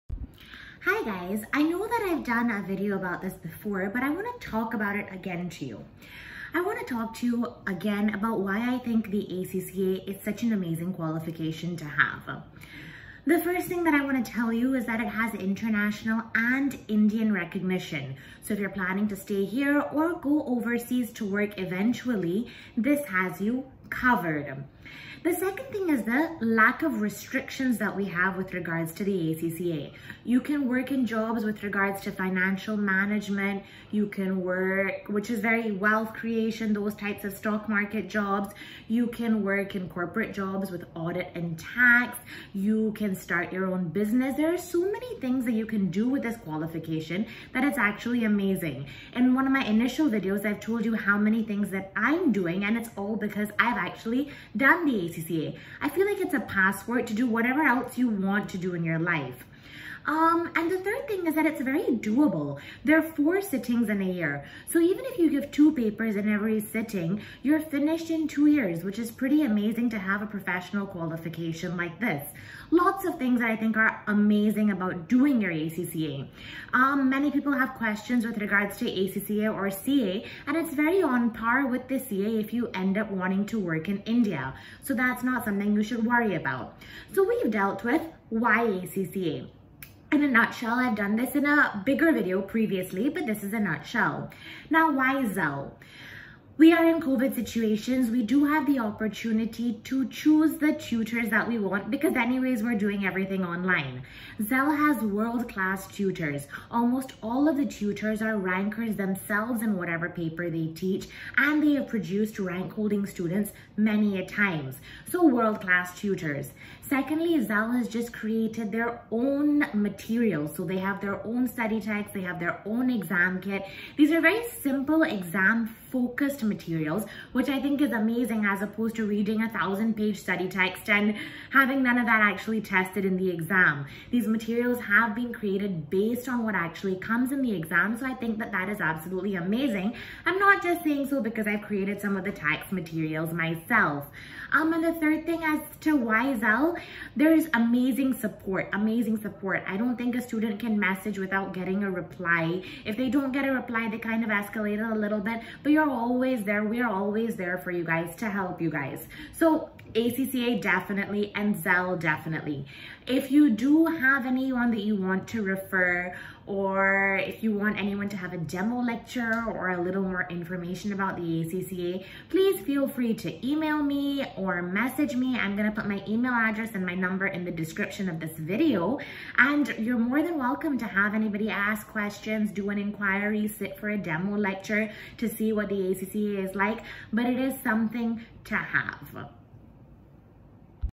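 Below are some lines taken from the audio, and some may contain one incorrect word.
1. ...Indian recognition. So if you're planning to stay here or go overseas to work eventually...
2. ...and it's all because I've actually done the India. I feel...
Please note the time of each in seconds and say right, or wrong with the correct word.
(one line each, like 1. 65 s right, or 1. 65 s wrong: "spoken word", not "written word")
1. 16 s right
2. 52 s wrong: "ACCA", not "India".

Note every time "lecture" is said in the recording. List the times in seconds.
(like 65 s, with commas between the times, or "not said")
168 s, 184 s.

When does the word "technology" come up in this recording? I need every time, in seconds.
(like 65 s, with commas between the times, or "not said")
not said.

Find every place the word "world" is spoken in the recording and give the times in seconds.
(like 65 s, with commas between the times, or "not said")
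105 s, 115 s.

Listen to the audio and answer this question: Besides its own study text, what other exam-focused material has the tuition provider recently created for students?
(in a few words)
exam kit.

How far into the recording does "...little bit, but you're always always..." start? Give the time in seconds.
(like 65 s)
155 s.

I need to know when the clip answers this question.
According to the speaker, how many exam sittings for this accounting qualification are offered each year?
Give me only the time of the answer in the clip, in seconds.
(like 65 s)
63 s.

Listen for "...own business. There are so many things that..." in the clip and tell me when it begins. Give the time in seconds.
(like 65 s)
43 s.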